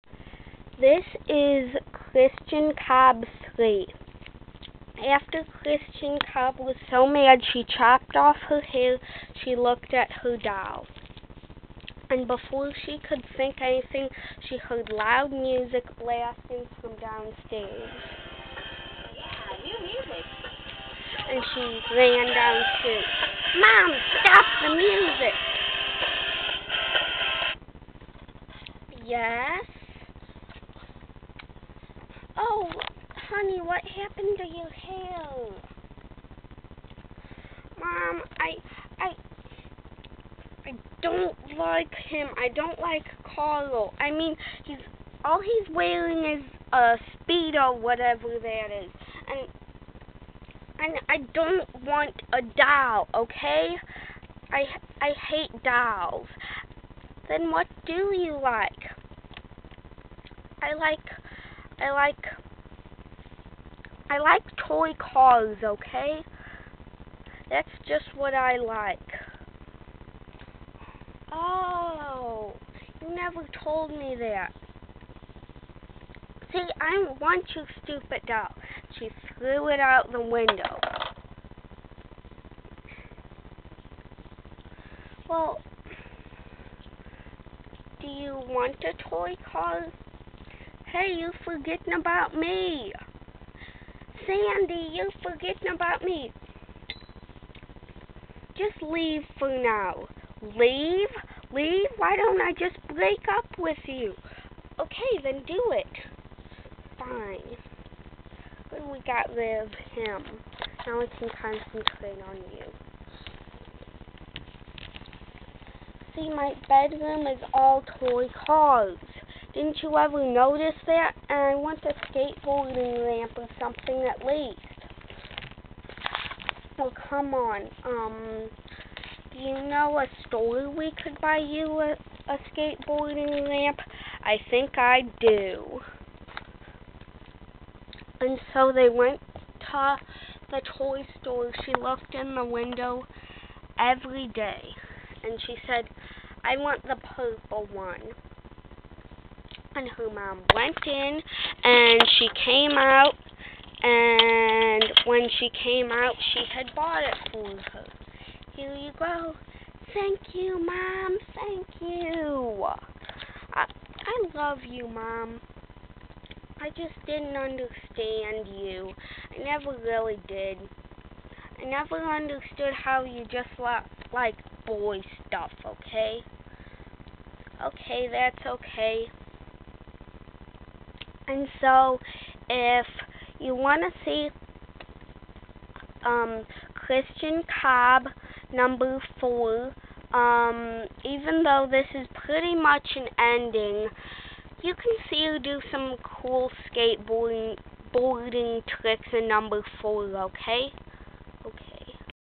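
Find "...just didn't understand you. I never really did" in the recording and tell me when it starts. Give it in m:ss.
2:46.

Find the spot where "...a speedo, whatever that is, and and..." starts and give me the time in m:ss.
0:46.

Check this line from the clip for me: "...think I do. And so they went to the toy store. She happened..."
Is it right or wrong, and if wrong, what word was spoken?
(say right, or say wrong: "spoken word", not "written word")
wrong: "looked", not "happened".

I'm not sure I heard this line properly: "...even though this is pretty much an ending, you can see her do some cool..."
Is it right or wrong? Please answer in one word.
right.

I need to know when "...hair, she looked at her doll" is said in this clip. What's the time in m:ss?
0:08.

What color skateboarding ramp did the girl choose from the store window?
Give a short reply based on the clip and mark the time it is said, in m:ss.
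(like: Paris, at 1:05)
Purple, at 2:27.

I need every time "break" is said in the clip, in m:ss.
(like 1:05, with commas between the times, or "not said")
1:42.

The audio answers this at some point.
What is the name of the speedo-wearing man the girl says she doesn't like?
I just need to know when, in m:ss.
0:43.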